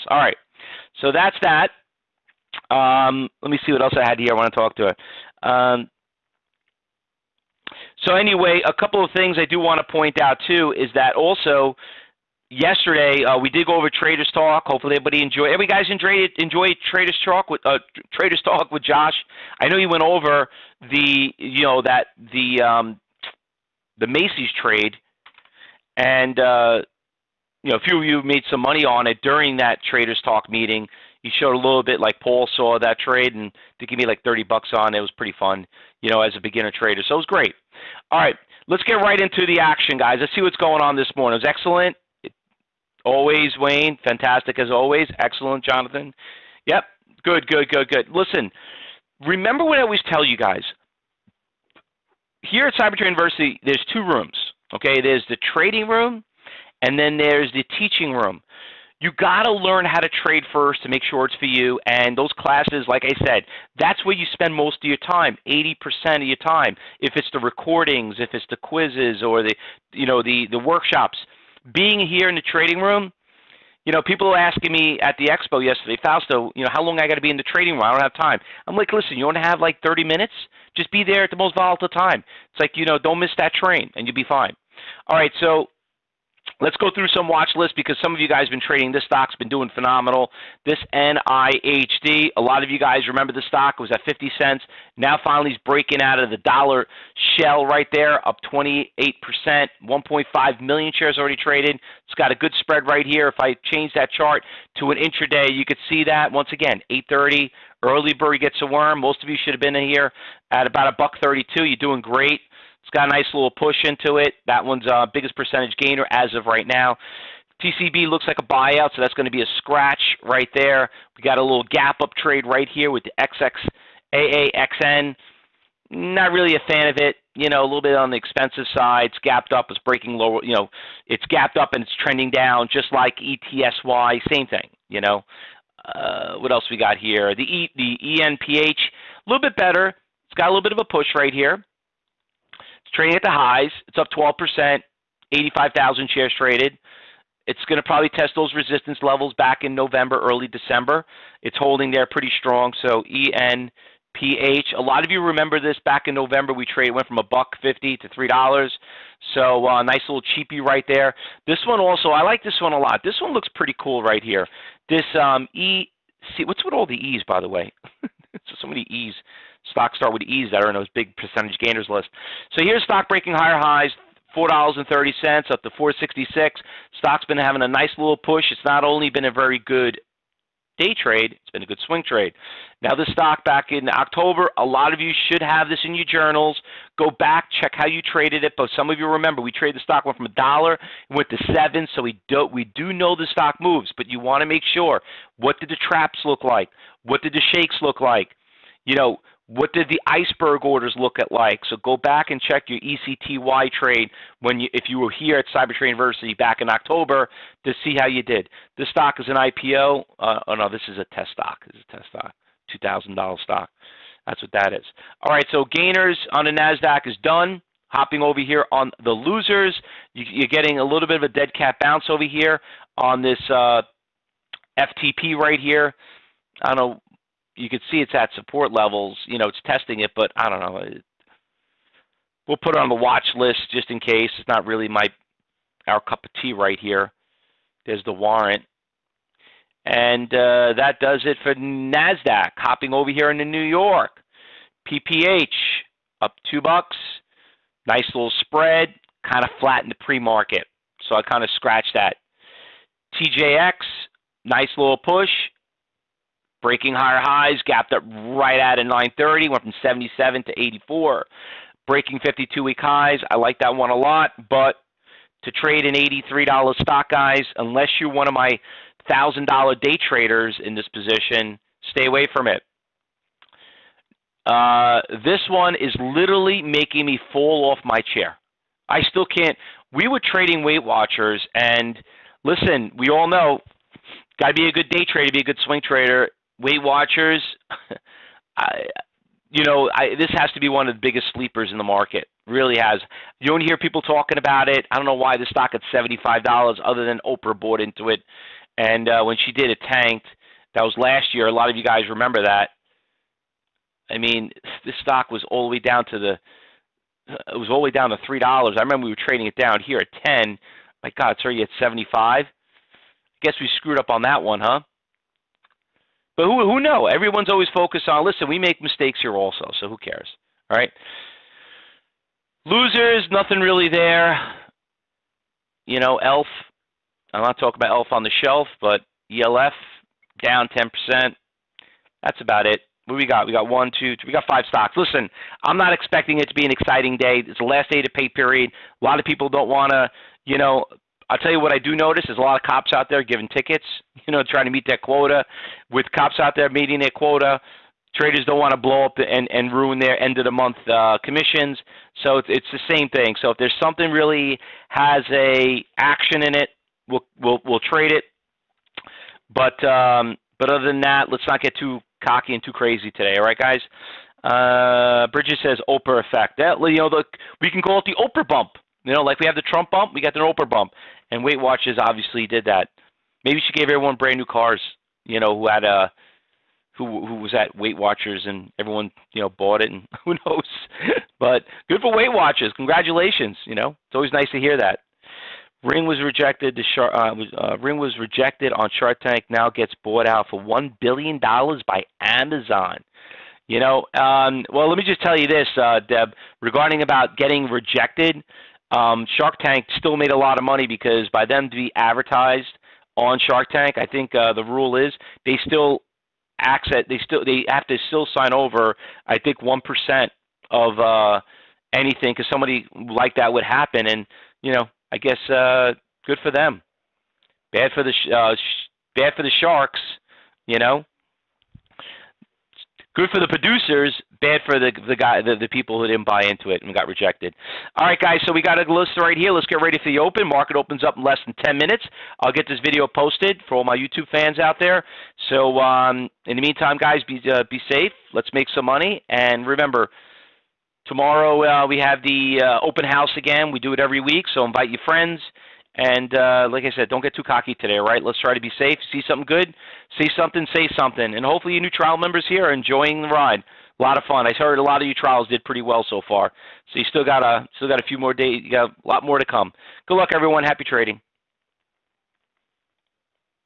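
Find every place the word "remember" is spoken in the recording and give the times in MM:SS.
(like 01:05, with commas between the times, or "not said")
00:49, 01:33, 02:35, 03:09, 05:02, 05:08, 07:19.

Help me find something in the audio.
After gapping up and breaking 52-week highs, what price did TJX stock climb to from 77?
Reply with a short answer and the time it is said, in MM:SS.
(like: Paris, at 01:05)
84, at 04:20.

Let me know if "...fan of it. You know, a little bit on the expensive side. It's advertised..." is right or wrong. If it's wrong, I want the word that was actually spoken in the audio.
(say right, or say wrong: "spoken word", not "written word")
wrong: "gapped", not "advertised".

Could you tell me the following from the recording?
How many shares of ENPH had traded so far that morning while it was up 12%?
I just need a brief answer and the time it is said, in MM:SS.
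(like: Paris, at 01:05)
85,000, at 02:25.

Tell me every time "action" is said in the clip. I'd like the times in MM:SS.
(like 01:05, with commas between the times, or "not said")
00:39, 05:55.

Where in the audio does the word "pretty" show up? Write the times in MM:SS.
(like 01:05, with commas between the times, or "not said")
00:35, 02:32, 02:43, 07:35.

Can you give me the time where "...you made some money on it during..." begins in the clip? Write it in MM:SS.
00:28.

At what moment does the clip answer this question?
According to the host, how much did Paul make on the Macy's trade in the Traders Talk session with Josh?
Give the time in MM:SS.
00:34.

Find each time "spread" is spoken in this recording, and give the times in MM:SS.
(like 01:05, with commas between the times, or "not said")
01:42, 04:08.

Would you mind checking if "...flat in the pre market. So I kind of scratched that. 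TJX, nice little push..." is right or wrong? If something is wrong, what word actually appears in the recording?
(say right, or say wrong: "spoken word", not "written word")
right.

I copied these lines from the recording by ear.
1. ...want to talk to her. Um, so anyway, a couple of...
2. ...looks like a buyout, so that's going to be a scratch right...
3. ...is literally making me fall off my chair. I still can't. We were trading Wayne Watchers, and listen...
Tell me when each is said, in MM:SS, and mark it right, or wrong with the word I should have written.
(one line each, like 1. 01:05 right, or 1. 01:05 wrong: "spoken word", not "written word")
1. 00:04 right
2. 01:58 right
3. 04:35 wrong: "Weight", not "Wayne".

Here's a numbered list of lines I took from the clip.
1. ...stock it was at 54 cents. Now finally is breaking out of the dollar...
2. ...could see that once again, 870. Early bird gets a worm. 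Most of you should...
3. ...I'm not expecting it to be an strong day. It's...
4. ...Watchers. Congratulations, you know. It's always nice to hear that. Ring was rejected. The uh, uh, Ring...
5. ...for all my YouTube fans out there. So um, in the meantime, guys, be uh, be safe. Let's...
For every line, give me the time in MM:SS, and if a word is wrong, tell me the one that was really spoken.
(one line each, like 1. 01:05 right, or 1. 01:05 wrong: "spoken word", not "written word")
1. 01:33 wrong: "50", not "54"
2. 01:45 wrong: "830", not "870"
3. 05:35 wrong: "exciting", not "strong"
4. 06:22 right
5. 07:13 right.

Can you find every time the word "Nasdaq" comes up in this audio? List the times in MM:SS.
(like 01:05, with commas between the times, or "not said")
03:36, 04:01.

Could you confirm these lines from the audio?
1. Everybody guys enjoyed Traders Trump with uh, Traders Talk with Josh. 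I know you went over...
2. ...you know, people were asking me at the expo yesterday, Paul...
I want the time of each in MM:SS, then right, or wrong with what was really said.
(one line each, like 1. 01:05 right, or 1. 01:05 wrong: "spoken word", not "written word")
1. 00:15 wrong: "Talk", not "Trump"
2. 01:13 wrong: "Fausto", not "Paul".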